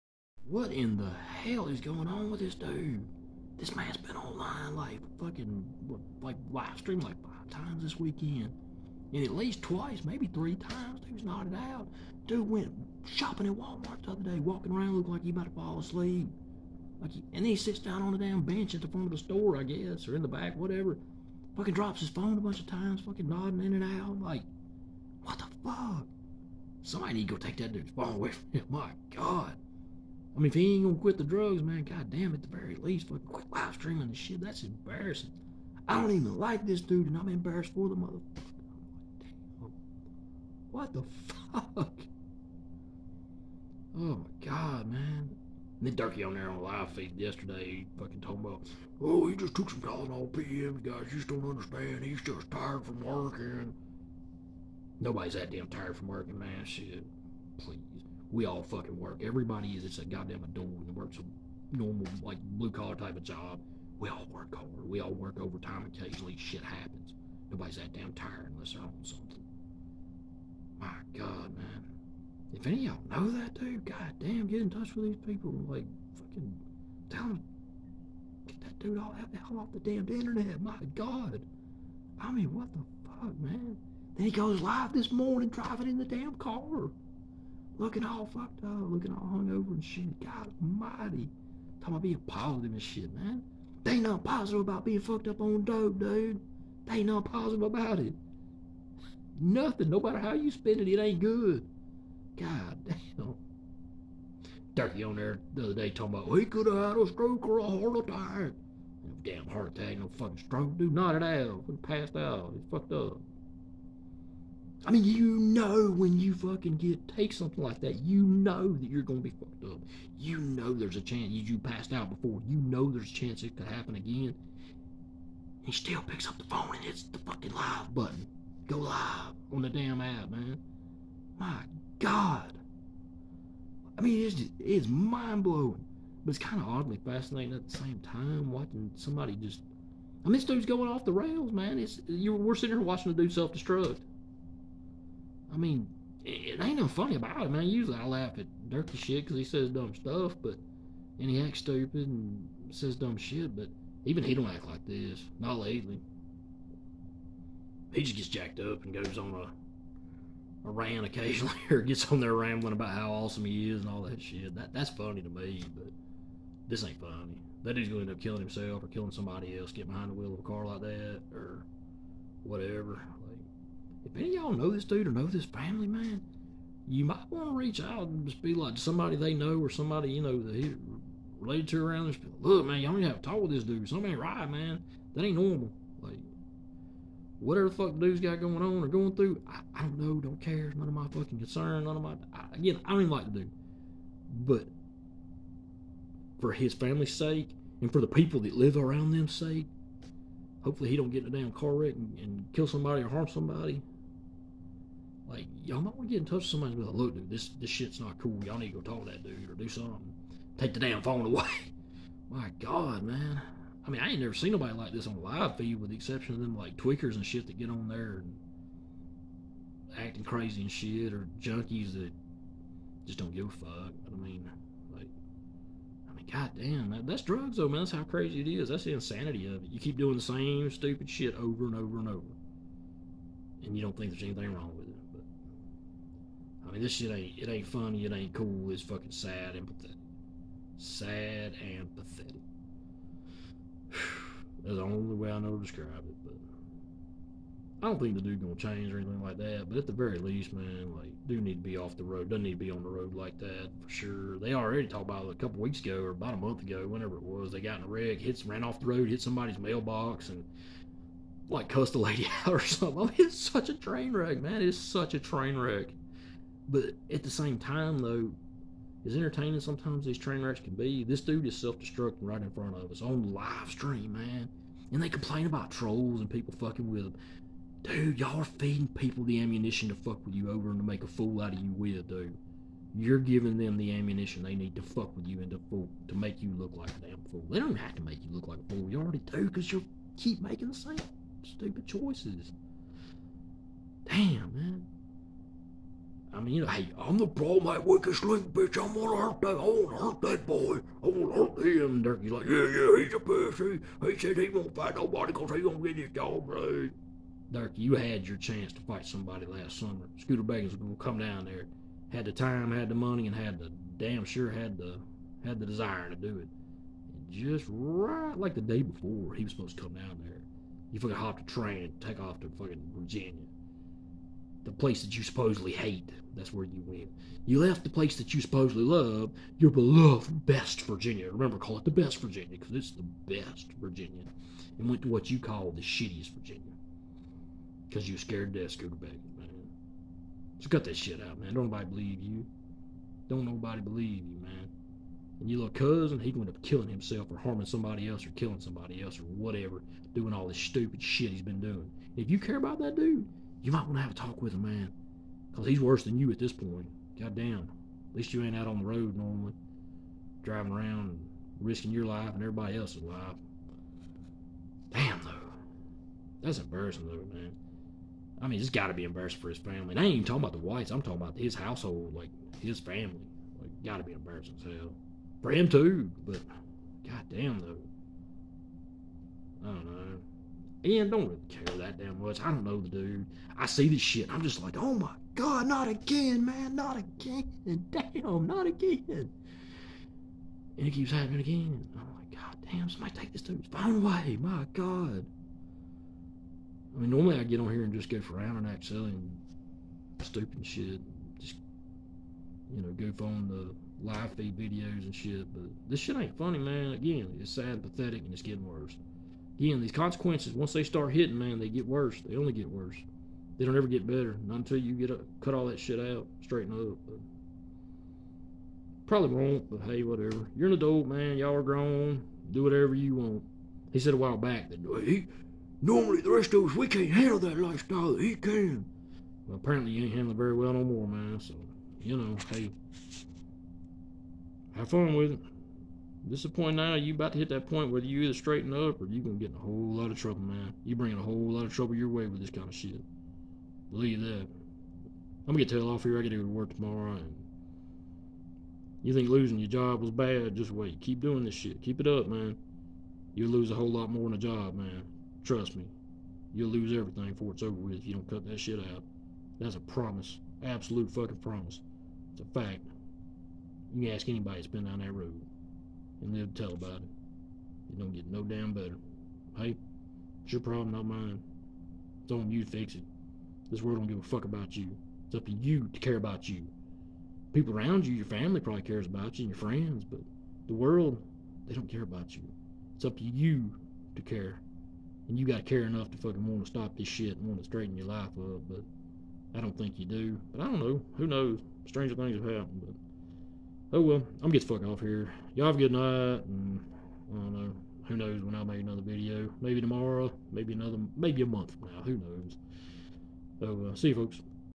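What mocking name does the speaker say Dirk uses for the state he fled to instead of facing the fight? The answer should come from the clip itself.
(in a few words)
the shittiest Virginia.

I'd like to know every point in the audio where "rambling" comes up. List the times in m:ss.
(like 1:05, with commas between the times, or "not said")
2:42.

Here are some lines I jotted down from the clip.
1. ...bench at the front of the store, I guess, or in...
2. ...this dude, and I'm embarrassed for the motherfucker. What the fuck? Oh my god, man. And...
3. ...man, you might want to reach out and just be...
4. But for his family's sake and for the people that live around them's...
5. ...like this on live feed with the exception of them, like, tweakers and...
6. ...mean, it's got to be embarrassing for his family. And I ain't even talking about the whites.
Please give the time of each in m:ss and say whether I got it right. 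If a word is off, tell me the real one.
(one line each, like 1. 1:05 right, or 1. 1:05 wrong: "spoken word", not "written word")
1. 0:18 right
2. 0:36 right
3. 2:55 right
4. 3:14 right
5. 3:34 right
6. 6:08 right.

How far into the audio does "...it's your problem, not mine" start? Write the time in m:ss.
7:50.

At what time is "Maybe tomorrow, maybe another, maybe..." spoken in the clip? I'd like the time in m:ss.
8:19.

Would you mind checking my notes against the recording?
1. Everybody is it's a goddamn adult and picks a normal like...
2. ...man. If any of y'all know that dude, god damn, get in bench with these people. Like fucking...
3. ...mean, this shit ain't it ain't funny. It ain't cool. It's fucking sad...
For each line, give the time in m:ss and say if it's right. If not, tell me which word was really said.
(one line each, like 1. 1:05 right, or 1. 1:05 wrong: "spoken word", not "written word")
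1. 0:59 wrong: "works", not "picks"
2. 1:11 wrong: "touch", not "bench"
3. 3:56 right.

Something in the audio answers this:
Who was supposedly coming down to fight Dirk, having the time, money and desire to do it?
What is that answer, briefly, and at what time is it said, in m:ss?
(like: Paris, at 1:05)
Scooter Baggins, at 5:10.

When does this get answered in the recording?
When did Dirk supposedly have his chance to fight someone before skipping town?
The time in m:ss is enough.
5:09.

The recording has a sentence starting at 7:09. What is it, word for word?
Well, apparently you ain't handling very well no more, man.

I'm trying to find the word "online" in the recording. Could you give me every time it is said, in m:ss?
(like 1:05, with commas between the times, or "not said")
0:04.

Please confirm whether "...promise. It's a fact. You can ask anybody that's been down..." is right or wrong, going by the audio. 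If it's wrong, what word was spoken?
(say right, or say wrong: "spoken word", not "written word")
right.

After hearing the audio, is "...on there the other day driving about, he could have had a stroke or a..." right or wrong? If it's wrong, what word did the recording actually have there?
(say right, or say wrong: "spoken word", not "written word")
wrong: "talking", not "driving".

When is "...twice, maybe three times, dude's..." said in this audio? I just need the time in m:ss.
0:09.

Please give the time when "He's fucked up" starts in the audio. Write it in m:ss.
1:52.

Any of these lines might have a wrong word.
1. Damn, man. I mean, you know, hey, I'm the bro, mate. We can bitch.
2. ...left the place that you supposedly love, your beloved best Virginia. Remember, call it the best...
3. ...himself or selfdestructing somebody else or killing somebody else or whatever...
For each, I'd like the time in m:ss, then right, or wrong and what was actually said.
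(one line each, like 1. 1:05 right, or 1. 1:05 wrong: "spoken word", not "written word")
1. 4:54 right
2. 5:27 right
3. 5:46 wrong: "harming", not "selfdestructing".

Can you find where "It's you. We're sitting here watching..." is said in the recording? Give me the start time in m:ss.
2:21.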